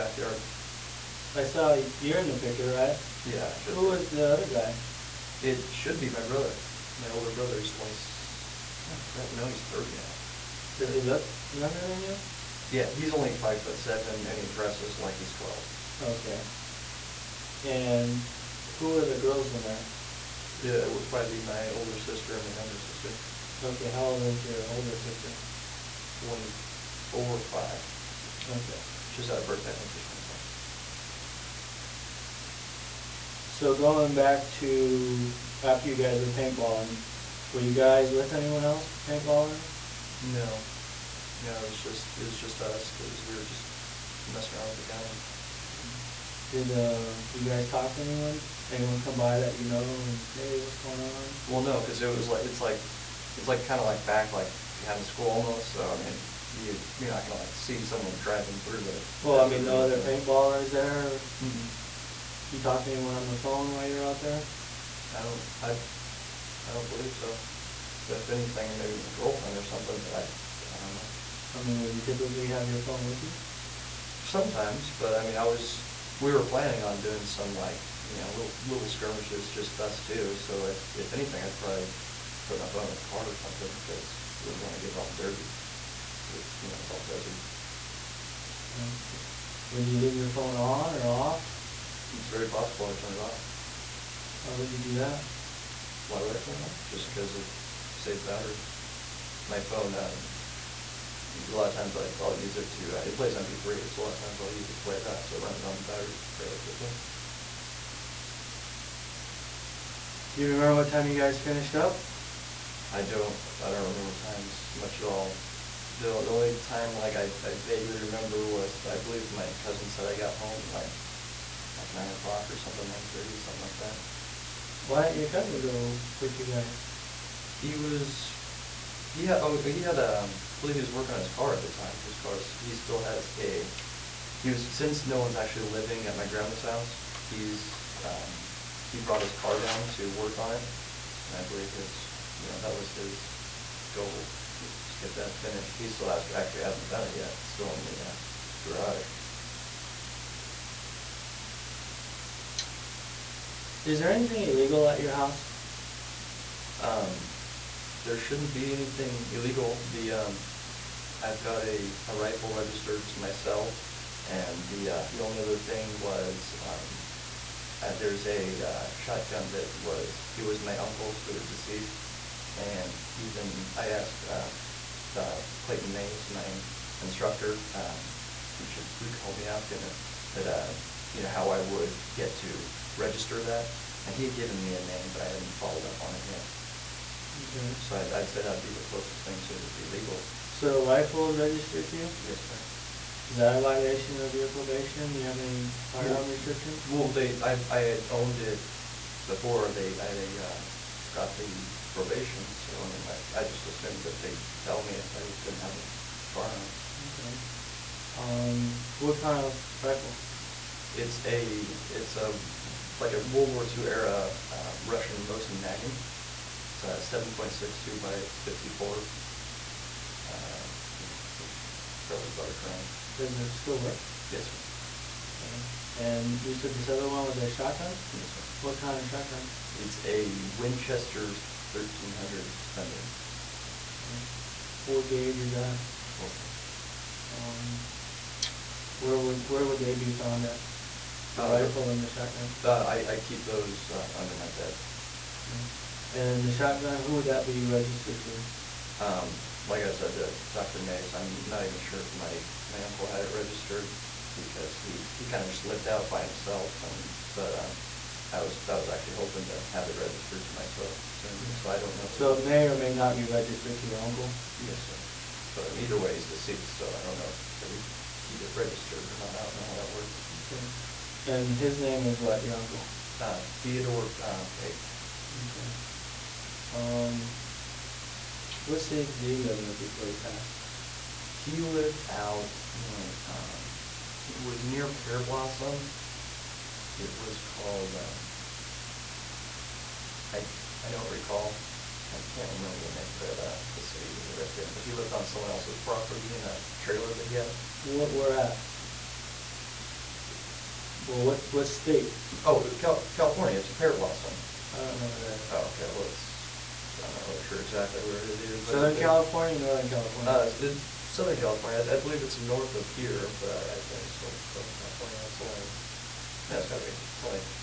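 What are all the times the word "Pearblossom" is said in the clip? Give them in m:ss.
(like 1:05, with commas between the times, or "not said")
4:44, 5:03.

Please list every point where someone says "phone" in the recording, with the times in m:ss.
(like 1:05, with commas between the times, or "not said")
1:03, 1:12, 1:22, 1:30, 1:39.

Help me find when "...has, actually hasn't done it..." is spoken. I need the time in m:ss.
2:26.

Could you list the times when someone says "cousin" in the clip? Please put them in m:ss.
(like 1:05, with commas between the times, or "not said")
1:59, 2:05.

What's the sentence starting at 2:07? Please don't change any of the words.
He was, he had oh he had um I believe he was working on his car at the time.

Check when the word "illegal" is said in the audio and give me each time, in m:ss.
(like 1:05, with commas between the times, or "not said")
2:34, 2:39.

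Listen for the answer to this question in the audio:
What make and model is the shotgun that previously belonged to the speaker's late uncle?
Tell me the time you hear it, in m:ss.
3:50.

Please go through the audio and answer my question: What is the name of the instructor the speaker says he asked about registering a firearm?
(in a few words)
Clayton Mays.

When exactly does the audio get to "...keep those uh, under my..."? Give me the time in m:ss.
4:03.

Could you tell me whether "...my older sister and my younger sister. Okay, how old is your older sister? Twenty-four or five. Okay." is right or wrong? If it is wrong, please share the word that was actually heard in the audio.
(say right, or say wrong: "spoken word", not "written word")
right.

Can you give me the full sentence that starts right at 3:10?
So a rifle is registered to you?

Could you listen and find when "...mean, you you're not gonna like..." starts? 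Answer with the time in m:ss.
0:56.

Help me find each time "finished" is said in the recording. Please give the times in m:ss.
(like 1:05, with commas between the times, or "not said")
1:51, 2:25.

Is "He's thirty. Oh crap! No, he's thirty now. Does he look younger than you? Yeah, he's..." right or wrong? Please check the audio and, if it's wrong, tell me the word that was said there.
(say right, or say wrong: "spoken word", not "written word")
wrong: "twenty", not "thirty".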